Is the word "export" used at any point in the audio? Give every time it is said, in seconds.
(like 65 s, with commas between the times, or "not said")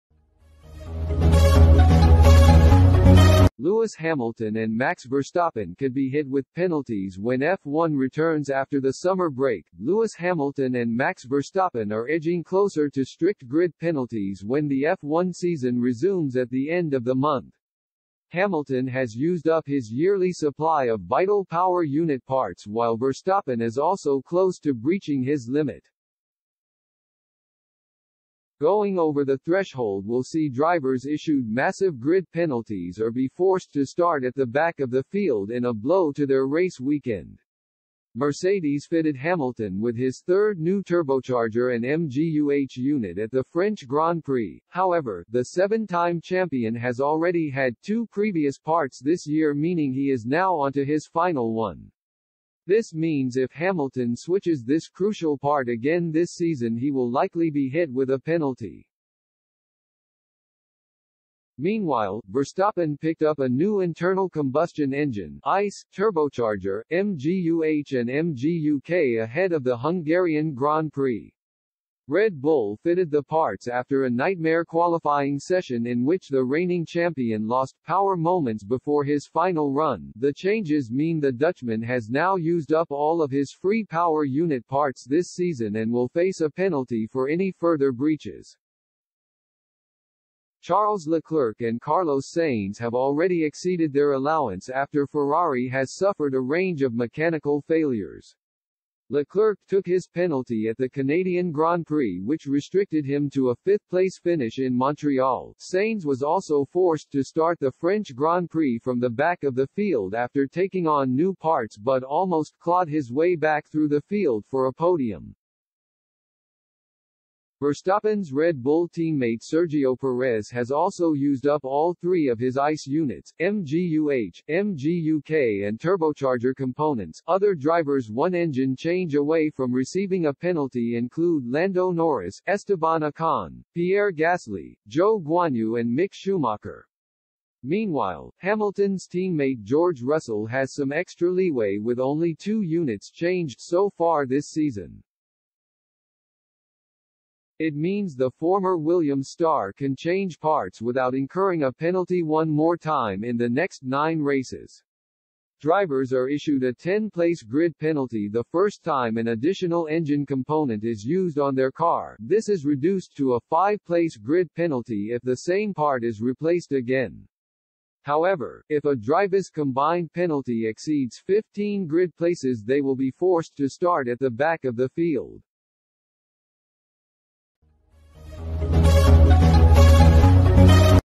not said.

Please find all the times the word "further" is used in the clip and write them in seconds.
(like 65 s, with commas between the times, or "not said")
87 s.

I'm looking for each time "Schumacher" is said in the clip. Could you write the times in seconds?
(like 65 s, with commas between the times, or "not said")
136 s.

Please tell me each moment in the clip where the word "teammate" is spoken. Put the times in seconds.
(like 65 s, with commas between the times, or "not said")
118 s, 139 s.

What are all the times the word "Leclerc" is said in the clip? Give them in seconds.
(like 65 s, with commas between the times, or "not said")
91 s, 99 s.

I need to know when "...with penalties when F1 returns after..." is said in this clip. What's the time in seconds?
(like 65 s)
6 s.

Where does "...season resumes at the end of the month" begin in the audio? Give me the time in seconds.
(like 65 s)
15 s.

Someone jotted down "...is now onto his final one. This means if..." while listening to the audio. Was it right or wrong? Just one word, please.
right.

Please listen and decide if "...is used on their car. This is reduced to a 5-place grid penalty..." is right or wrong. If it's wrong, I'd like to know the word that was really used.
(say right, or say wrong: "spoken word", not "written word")
right.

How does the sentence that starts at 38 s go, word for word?
Mercedes fitted Hamilton with his third new turbocharger and MGUH unit at the French Grand Prix.